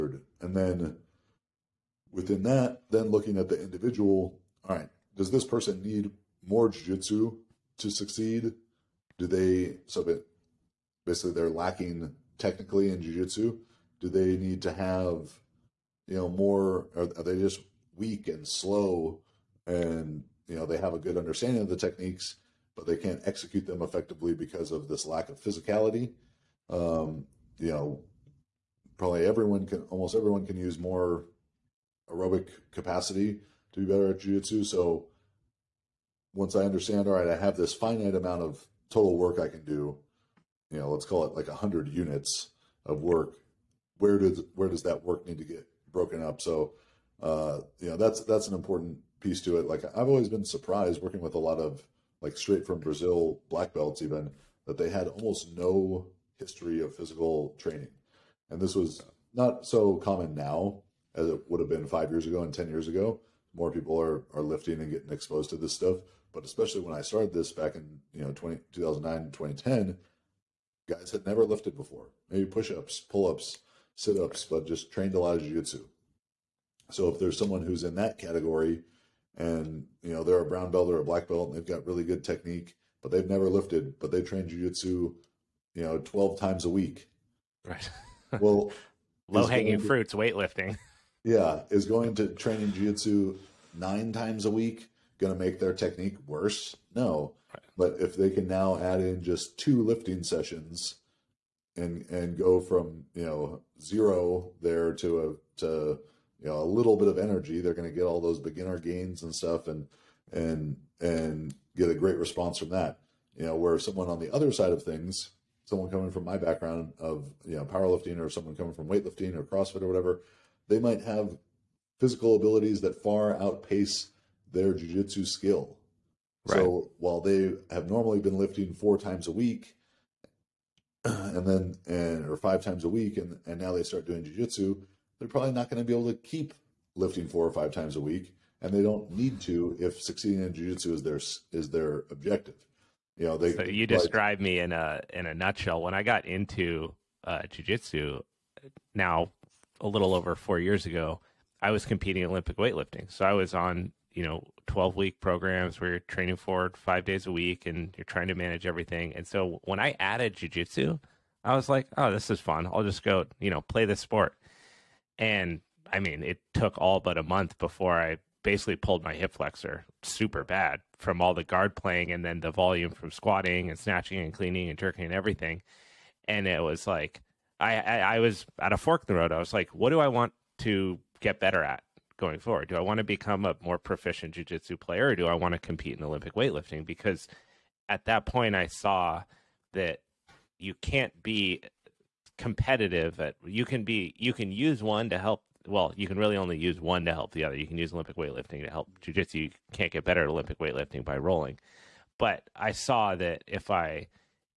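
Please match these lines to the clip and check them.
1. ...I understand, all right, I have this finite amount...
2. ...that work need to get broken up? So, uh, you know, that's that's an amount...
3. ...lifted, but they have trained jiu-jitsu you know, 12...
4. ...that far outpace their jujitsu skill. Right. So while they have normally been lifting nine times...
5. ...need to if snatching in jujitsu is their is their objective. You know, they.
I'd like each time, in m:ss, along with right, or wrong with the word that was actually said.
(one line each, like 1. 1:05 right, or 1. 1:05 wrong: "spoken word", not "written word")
1. 0:36 right
2. 0:44 wrong: "important", not "amount"
3. 1:23 right
4. 2:02 wrong: "four", not "nine"
5. 2:19 wrong: "succeeding", not "snatching".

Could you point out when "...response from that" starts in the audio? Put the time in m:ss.
1:52.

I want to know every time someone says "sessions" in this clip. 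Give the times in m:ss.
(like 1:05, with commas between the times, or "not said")
1:40.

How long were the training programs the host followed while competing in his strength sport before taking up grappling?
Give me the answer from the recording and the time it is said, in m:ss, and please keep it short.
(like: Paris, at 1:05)
12 weeks, at 2:34.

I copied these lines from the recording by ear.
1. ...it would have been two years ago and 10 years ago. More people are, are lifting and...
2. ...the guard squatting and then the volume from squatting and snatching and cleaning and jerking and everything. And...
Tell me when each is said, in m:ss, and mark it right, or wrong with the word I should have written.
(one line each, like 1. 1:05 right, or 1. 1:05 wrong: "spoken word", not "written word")
1. 1:01 wrong: "five", not "two"
2. 2:51 wrong: "playing", not "squatting".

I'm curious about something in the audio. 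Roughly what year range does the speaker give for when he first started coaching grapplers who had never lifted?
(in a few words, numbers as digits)
2009, 2010.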